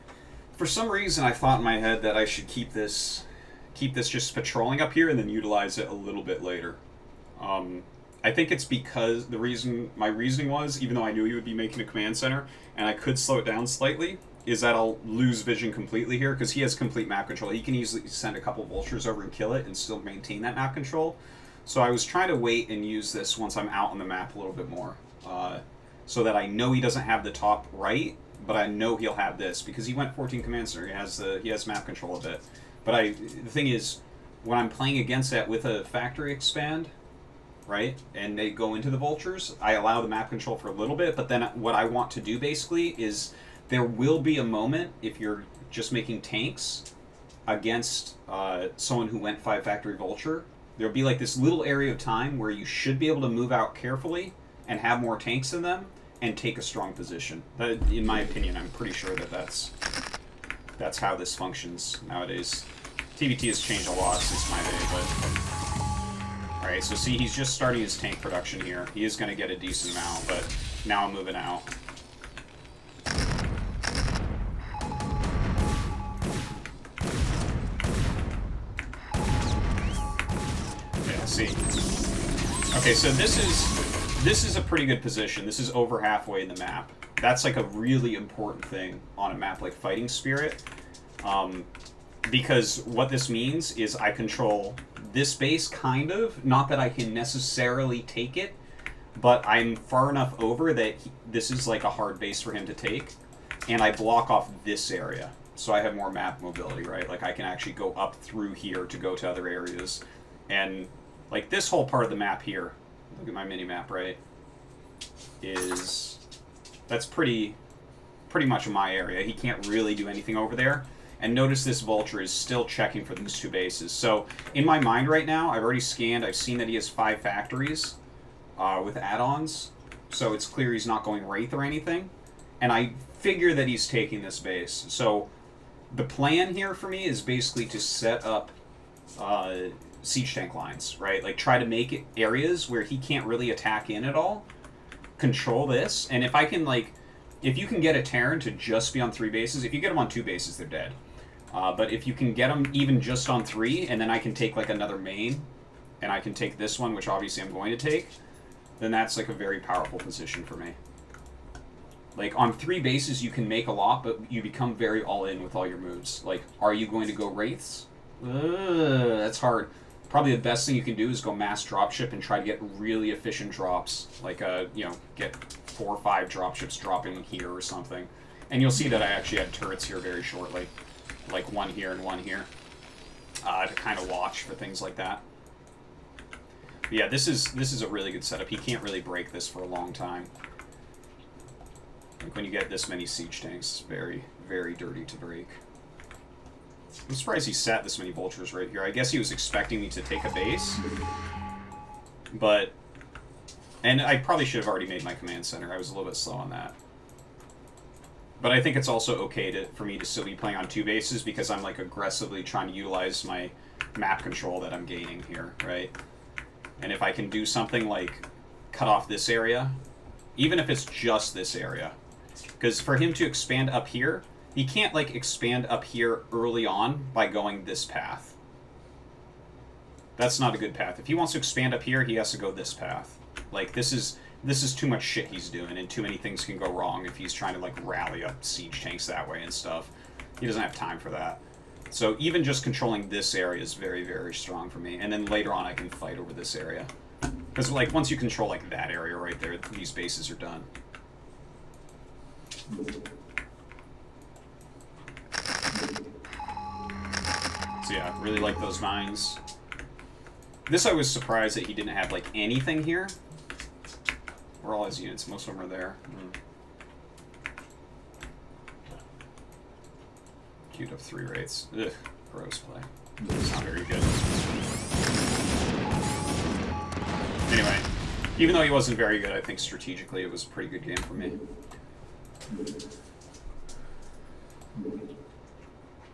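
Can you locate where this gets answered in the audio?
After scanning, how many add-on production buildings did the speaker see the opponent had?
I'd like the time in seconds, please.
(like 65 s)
126 s.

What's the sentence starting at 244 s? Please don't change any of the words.
And then later on, I can fight over this area.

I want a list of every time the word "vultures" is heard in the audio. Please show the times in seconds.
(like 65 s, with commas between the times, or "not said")
18 s, 38 s, 49 s, 121 s, 198 s.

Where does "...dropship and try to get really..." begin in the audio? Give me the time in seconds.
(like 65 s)
171 s.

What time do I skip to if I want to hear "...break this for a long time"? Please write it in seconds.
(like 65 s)
189 s.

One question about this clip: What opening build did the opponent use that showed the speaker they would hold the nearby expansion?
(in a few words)
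14 commander.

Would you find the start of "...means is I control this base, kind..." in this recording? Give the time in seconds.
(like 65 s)
93 s.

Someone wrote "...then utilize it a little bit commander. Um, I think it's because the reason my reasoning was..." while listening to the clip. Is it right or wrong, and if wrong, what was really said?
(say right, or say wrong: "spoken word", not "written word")
wrong: "later", not "commander".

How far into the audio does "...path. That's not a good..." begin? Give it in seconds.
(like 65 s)
227 s.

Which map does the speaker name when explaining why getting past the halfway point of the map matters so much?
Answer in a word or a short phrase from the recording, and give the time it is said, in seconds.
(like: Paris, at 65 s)
Fighting Spirit, at 89 s.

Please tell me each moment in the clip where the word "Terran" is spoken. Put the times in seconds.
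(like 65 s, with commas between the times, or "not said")
148 s.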